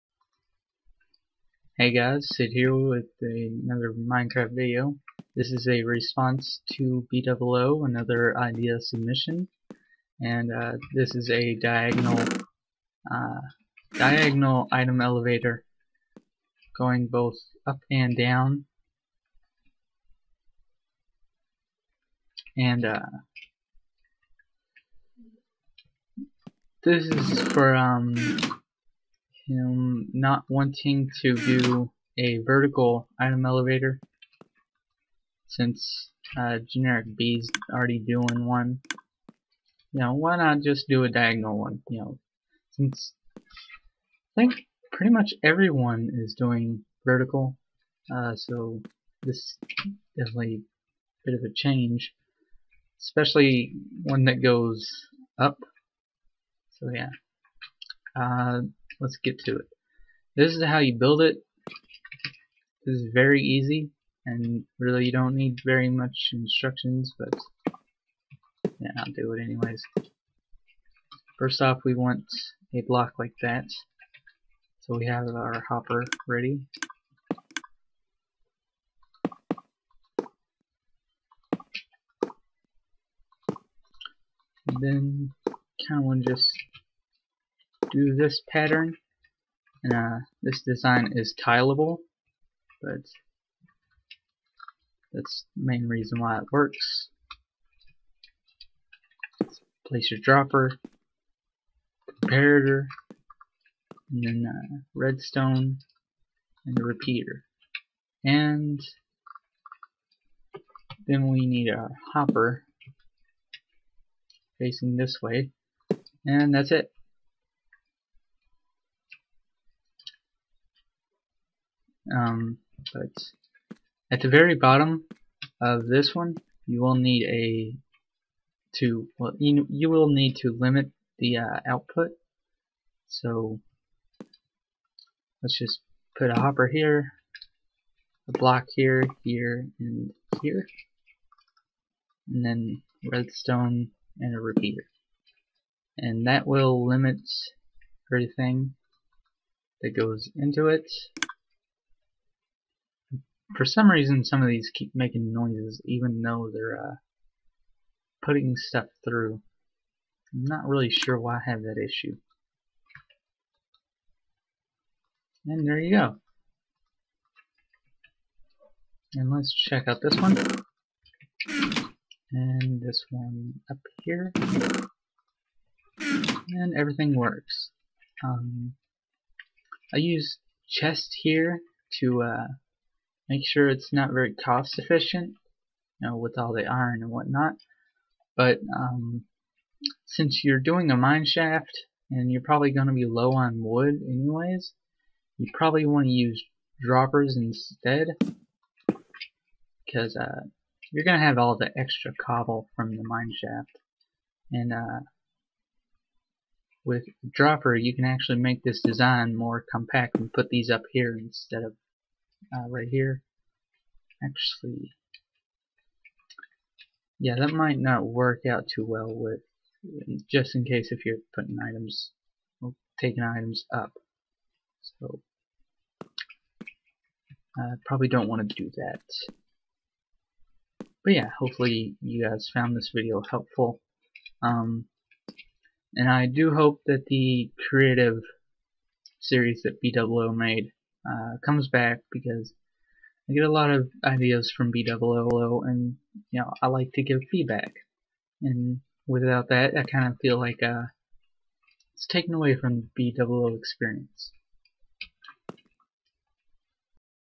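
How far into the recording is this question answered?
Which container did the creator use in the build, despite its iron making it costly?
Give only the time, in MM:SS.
03:00.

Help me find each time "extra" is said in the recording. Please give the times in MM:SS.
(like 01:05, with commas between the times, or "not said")
03:21.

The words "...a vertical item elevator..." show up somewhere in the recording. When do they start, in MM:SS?
00:32.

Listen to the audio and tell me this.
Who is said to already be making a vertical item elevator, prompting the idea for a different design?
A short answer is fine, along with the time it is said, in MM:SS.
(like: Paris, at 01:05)
Generic B, at 00:36.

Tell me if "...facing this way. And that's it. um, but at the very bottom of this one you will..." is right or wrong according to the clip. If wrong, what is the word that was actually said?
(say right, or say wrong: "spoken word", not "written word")
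right.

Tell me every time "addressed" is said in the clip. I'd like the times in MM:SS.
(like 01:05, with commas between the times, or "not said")
not said.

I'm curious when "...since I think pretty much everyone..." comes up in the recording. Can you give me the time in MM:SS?
00:42.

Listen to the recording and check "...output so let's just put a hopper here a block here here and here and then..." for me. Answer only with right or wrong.
right.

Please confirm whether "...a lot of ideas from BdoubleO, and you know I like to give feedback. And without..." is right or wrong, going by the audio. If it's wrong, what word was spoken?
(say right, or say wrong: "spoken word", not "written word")
right.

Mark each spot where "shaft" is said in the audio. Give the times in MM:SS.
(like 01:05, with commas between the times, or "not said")
03:11, 03:23.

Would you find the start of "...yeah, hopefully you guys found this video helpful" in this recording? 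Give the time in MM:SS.
03:51.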